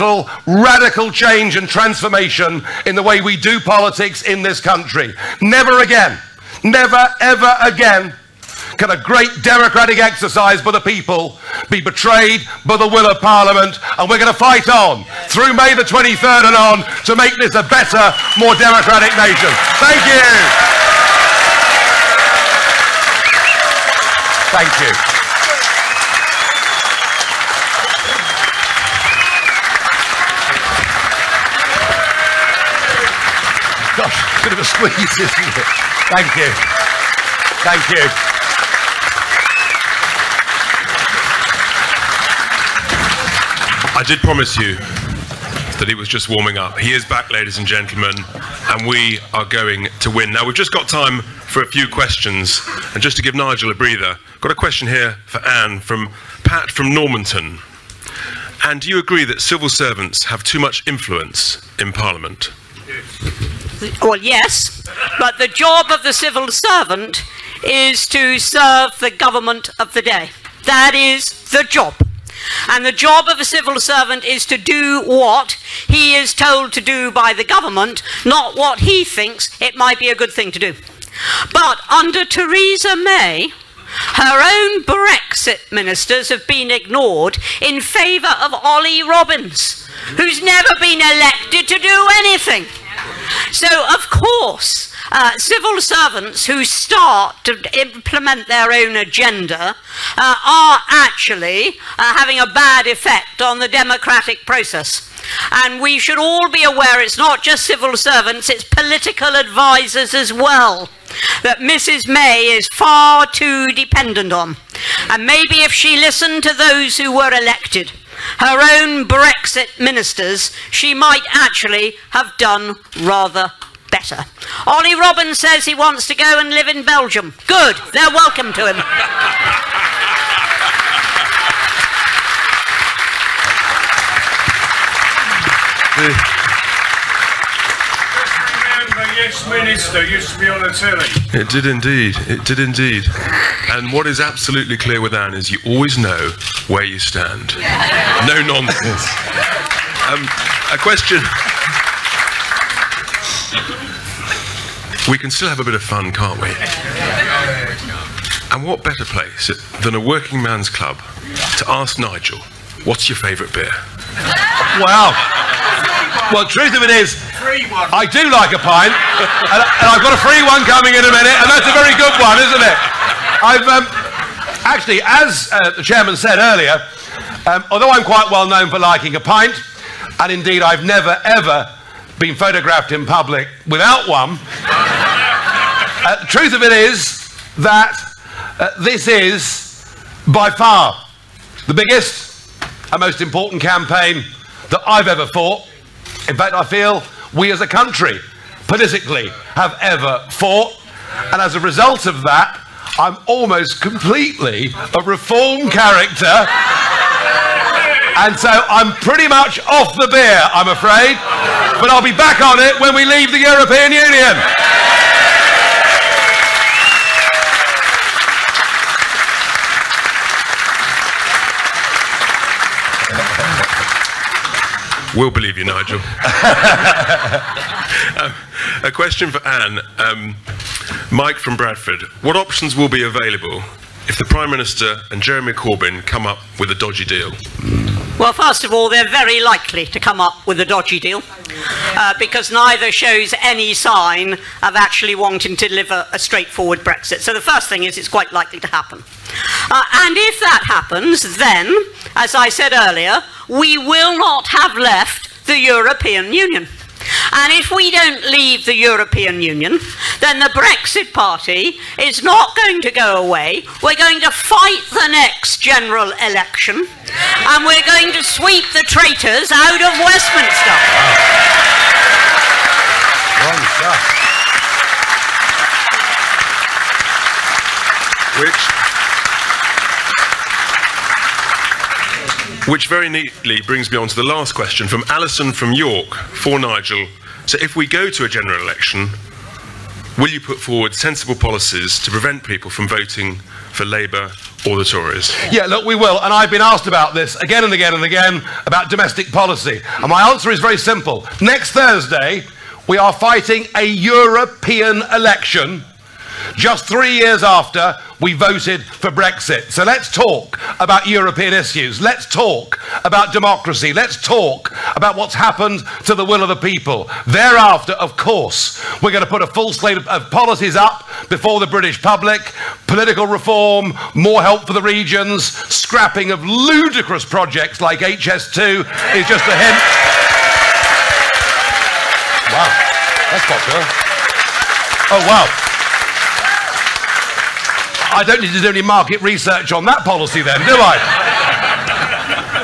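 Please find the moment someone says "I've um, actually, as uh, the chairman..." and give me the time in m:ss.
2:53.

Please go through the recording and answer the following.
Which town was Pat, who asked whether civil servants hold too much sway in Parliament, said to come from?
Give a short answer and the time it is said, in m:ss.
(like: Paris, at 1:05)
Normanton, at 0:56.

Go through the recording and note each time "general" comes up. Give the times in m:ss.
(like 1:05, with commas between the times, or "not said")
4:25, 4:48.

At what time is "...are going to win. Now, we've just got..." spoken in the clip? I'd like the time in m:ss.
0:49.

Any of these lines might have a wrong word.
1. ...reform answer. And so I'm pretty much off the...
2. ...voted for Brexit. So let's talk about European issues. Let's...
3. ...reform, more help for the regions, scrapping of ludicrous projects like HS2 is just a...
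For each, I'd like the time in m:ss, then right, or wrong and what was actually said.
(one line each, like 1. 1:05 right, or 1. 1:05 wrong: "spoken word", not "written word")
1. 3:25 wrong: "character", not "answer"
2. 5:08 right
3. 5:23 right.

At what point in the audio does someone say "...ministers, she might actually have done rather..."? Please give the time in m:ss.
1:59.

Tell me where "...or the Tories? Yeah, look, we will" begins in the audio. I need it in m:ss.
4:54.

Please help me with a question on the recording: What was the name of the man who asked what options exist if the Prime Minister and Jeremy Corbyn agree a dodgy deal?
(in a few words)
Mike.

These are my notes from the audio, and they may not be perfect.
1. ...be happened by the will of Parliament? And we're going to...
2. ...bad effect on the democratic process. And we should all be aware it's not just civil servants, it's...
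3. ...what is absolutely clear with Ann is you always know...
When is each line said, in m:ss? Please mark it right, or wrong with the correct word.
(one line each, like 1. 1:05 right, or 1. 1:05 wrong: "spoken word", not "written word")
1. 0:11 wrong: "betrayed", not "happened"
2. 1:42 right
3. 2:23 right.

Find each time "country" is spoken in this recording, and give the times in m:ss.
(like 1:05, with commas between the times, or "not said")
0:04, 3:17.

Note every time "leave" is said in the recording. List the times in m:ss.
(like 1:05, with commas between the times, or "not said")
3:33, 4:18.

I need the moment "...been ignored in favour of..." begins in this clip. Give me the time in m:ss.
1:26.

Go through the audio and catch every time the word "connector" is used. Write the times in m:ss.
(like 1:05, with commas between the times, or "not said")
not said.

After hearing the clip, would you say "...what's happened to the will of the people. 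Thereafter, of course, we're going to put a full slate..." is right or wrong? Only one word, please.
right.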